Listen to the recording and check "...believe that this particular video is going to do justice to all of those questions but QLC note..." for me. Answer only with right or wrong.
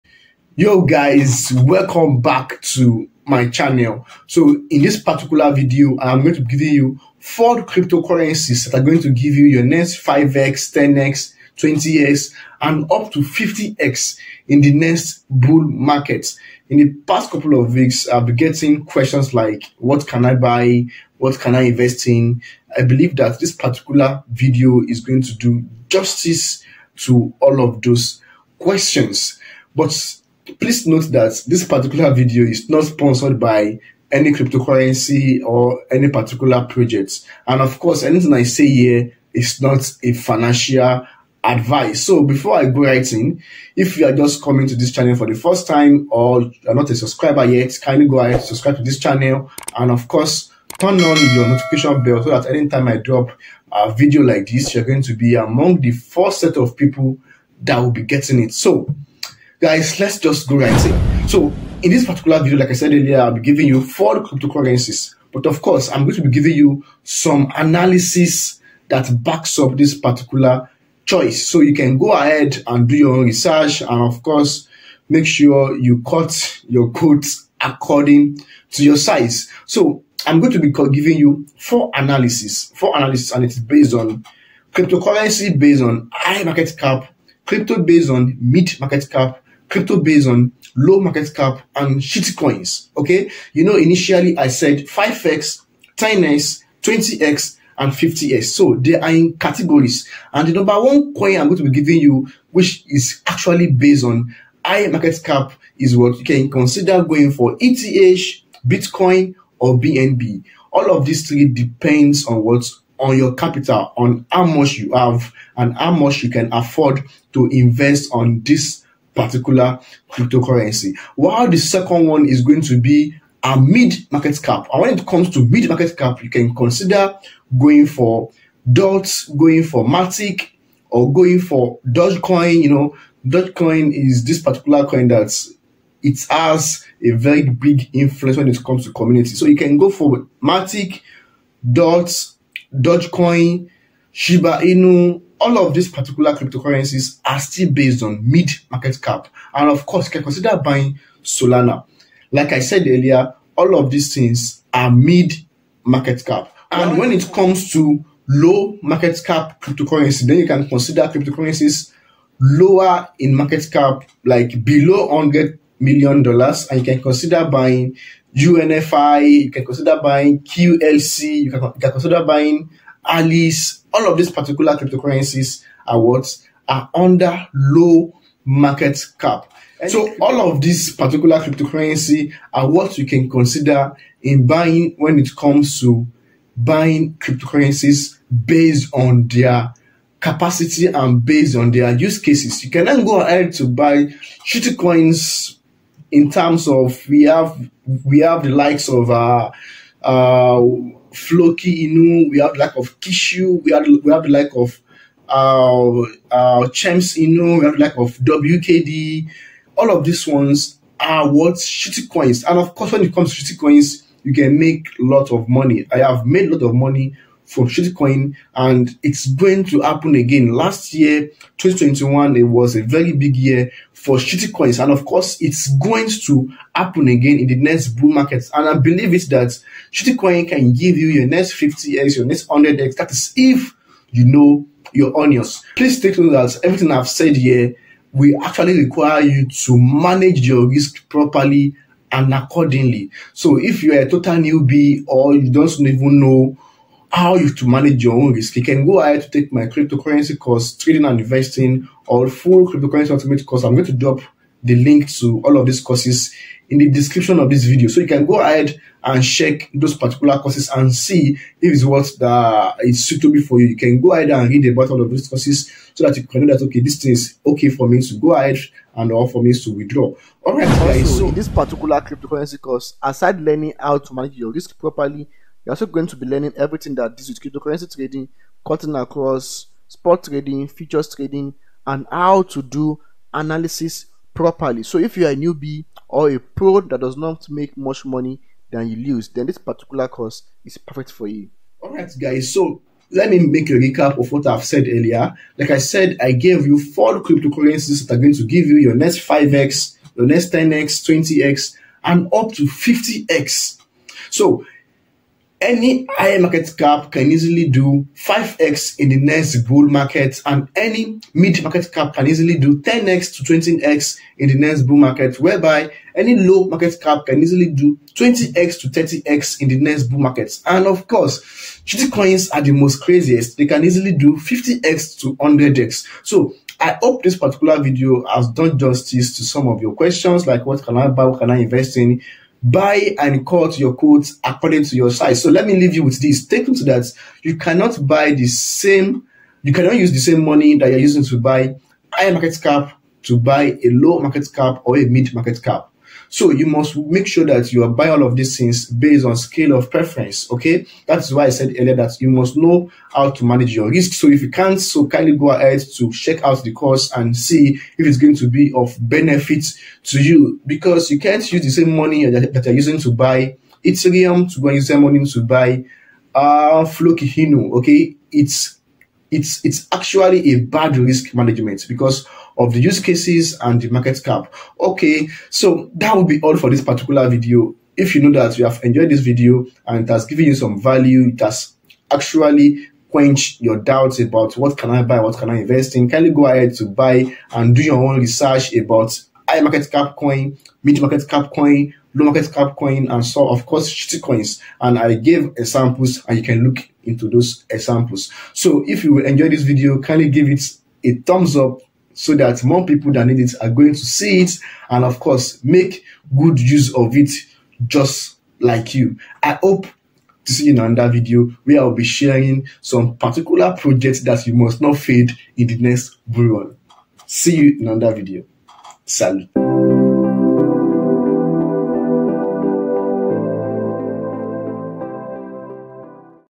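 wrong.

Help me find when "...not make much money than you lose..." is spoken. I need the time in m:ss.
4:47.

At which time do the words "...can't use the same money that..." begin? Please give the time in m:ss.
6:01.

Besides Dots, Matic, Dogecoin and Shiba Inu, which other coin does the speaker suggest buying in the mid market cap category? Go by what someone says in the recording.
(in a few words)
Solana.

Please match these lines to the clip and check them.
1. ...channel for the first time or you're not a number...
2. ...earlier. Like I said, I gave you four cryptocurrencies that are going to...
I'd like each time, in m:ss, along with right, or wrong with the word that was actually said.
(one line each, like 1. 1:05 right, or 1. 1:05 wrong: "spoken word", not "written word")
1. 0:44 wrong: "subscriber", not "number"
2. 4:54 right.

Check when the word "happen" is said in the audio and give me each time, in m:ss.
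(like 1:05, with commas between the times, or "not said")
3:39, 3:46.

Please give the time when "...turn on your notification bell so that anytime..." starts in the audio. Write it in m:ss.
0:50.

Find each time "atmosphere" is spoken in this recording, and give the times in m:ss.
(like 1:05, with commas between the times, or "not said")
not said.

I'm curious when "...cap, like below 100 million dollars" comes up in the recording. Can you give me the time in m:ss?
2:43.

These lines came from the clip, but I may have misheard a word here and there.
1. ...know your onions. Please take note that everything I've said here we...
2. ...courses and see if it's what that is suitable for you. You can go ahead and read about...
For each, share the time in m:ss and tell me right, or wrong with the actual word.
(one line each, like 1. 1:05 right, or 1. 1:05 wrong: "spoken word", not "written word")
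1. 3:54 right
2. 4:20 right.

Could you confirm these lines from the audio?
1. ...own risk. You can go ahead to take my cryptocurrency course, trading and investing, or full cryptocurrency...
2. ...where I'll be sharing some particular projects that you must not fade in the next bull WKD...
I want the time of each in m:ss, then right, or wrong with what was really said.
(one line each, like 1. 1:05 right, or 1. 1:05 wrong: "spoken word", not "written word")
1. 4:08 right
2. 6:51 wrong: "See", not "WKD".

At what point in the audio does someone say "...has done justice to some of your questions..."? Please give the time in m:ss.
5:28.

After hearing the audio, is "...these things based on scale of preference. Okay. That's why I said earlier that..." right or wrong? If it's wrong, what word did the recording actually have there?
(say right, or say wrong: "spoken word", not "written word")
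right.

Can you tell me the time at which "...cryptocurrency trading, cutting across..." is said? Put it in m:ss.
4:37.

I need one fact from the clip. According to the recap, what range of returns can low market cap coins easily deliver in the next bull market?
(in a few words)
20x to 30x.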